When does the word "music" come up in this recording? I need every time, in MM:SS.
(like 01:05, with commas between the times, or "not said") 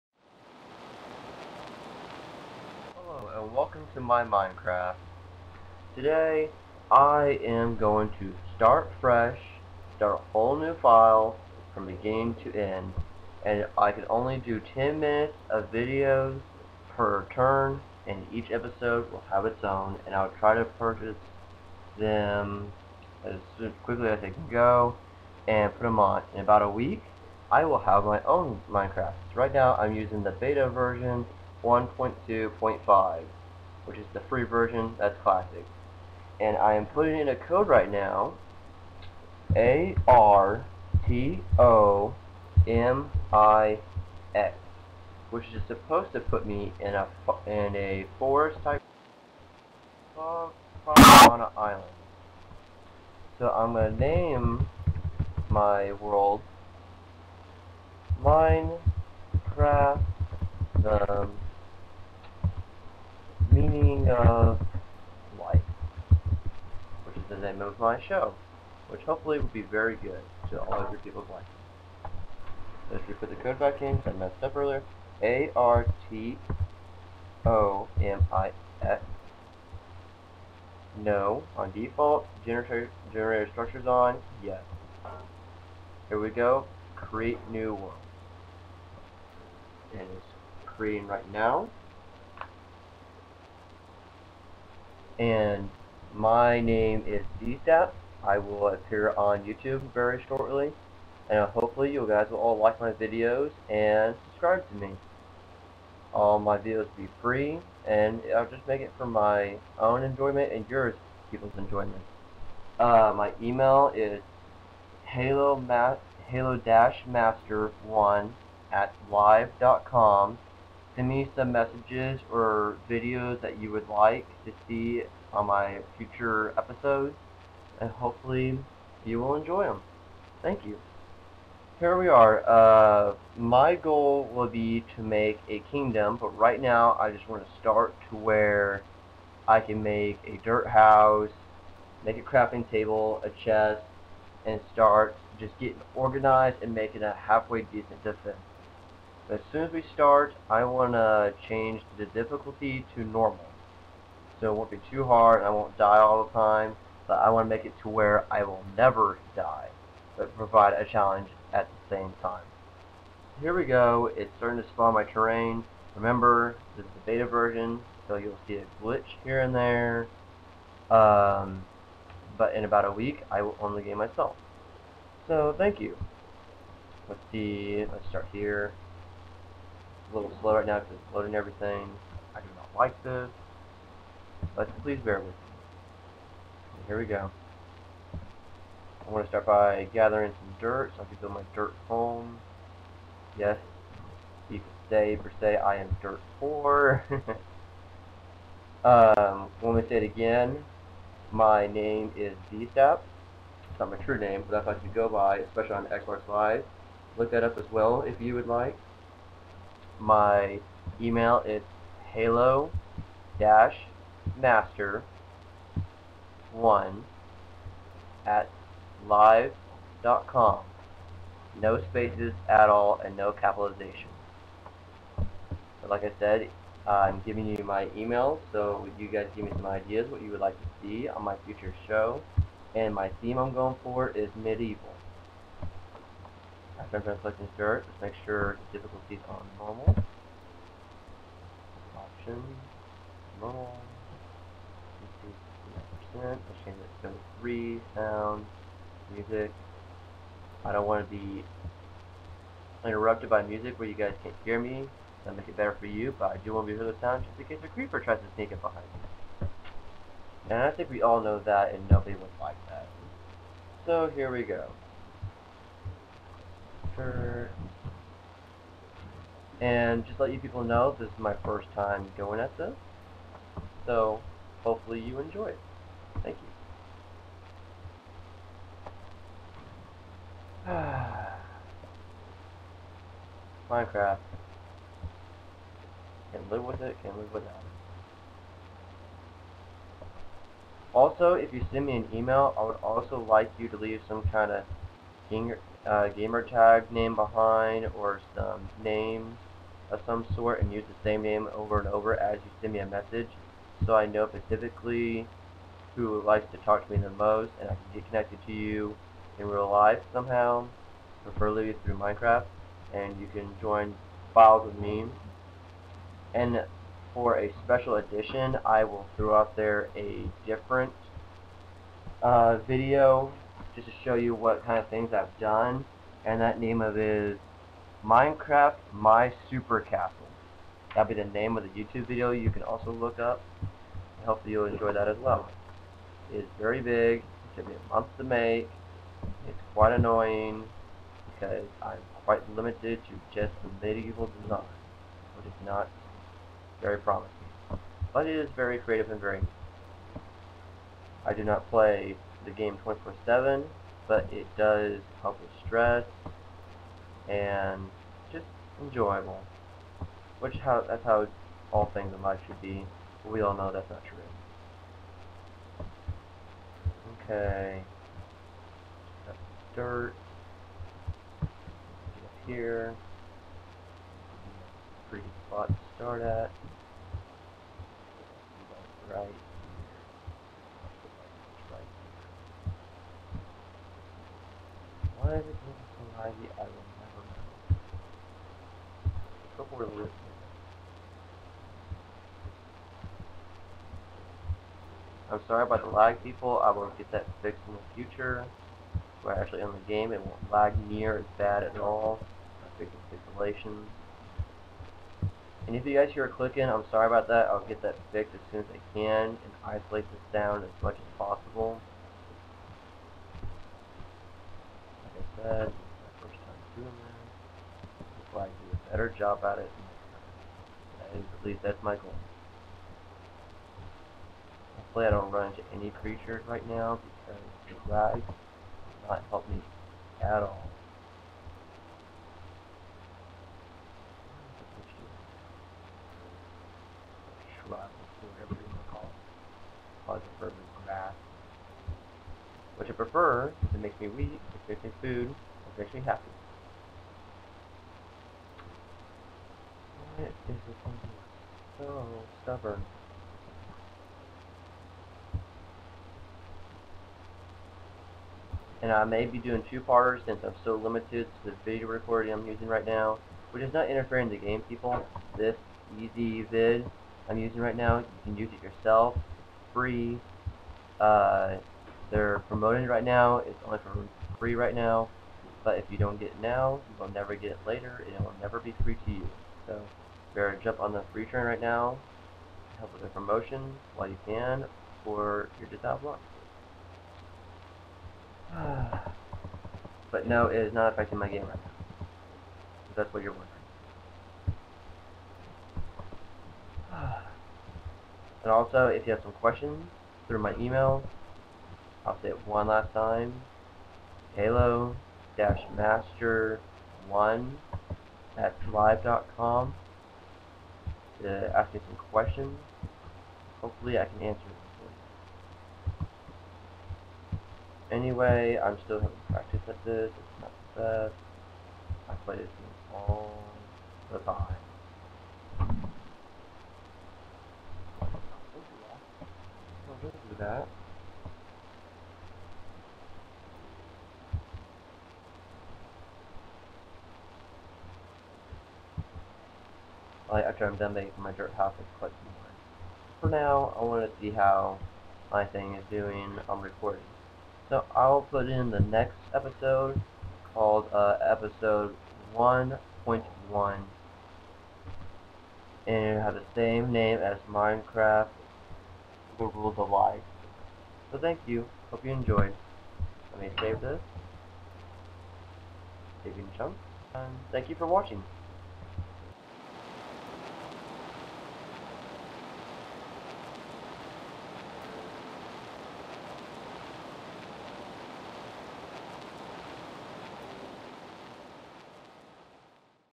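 04:09, 04:13.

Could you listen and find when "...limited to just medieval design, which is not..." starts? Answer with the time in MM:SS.
05:42.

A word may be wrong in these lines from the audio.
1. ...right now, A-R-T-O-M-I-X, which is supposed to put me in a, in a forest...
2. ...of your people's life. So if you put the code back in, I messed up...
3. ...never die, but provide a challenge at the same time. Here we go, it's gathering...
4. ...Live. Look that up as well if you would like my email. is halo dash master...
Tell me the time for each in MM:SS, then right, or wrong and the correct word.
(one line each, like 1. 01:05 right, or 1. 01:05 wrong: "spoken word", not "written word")
1. 00:37 right
2. 01:10 right
3. 02:38 wrong: "starting", not "gathering"
4. 03:26 right.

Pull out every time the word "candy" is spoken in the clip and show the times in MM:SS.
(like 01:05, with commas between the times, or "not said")
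not said.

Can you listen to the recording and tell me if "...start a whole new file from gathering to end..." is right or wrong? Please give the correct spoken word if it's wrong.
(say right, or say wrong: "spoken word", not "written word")
wrong: "beginning", not "gathering".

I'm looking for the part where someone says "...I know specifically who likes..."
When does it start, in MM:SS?
05:03.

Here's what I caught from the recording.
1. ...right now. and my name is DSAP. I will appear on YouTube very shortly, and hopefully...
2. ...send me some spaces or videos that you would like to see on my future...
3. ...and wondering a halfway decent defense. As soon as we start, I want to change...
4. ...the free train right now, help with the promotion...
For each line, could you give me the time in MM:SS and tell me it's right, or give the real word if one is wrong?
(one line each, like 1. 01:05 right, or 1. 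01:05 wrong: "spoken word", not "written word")
1. 01:31 right
2. 02:00 wrong: "messages", not "spaces"
3. 02:26 wrong: "making", not "wondering"
4. 08:00 right.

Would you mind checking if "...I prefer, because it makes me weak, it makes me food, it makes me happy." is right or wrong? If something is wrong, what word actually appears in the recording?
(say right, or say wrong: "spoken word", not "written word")
right.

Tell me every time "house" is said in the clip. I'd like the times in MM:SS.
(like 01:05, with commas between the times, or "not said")
02:20, 09:01.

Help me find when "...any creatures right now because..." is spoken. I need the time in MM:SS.
07:05.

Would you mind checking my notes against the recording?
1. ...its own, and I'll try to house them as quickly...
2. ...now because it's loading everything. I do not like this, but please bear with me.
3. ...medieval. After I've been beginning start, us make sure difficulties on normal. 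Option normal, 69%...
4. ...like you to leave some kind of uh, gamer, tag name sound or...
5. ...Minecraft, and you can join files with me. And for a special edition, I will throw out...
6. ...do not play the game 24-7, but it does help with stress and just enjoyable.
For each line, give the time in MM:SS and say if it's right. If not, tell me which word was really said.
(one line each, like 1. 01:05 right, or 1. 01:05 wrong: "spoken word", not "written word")
1. 00:19 wrong: "purchase", not "house"
2. 03:00 right
3. 03:54 wrong: "selecting", not "beginning"
4. 04:53 wrong: "behind", not "sound"
5. 05:11 right
6. 05:51 right.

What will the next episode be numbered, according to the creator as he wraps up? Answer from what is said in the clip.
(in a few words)
1.1.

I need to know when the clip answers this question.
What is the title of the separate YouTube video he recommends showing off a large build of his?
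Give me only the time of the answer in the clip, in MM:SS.
05:28.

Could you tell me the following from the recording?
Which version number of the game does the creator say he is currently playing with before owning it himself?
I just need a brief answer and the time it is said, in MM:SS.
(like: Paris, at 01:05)
1.2.5, at 00:31.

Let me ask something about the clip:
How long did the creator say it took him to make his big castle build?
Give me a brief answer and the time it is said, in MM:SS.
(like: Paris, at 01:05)
a month, at 05:37.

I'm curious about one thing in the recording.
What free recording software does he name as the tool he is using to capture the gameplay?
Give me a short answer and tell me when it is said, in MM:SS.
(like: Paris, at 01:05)
ezvid, at 07:45.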